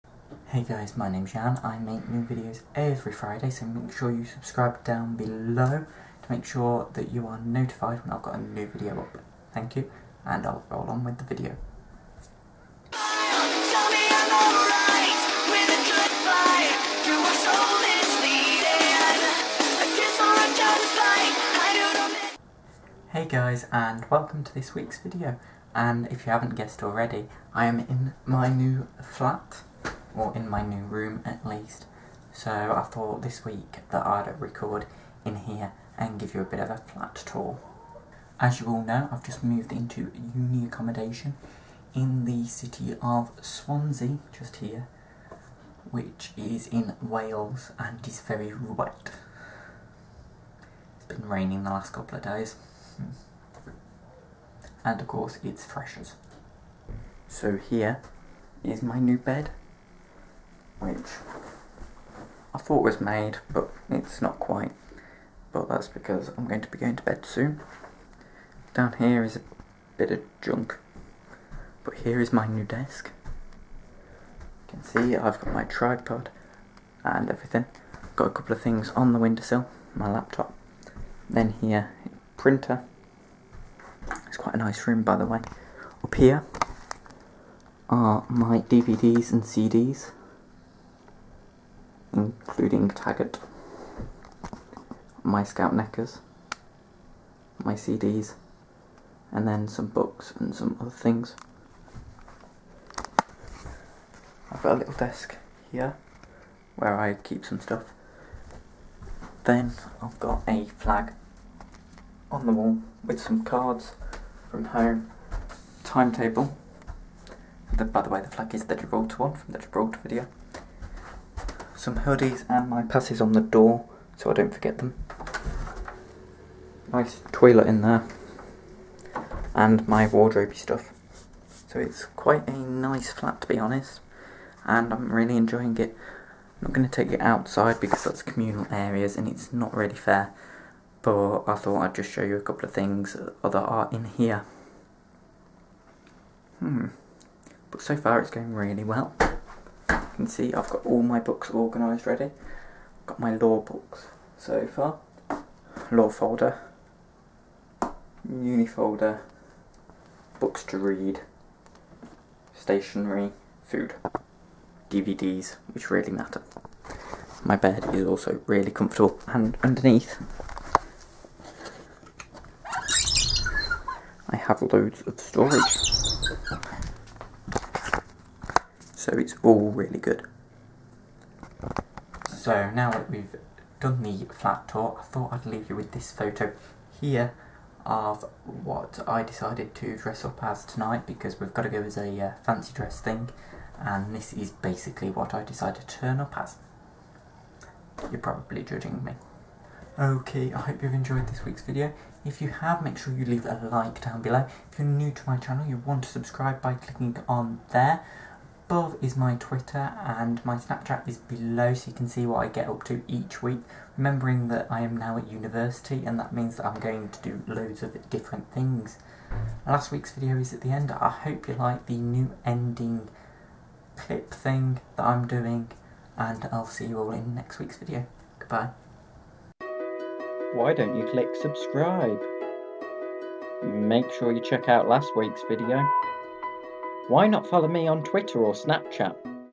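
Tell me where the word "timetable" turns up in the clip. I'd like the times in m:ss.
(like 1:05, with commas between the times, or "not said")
1:55.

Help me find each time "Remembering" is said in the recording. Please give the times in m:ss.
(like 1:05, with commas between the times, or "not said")
3:33.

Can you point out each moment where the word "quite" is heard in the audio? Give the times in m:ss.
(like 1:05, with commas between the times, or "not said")
1:04, 1:24, 2:12.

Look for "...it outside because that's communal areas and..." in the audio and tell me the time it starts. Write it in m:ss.
2:17.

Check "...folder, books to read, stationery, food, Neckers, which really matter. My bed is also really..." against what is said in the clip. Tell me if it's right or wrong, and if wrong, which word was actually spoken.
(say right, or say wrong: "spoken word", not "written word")
wrong: "DVDs", not "Neckers".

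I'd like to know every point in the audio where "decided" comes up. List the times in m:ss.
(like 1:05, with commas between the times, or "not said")
3:09, 3:15.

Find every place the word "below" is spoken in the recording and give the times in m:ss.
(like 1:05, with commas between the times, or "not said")
0:05, 3:24, 3:31.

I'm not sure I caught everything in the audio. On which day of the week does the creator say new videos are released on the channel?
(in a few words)
Friday.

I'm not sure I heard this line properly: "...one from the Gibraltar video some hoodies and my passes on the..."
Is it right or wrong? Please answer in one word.
right.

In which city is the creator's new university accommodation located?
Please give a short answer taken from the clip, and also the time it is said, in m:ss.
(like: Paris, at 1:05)
Swansea, at 0:43.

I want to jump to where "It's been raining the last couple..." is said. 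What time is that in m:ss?
0:50.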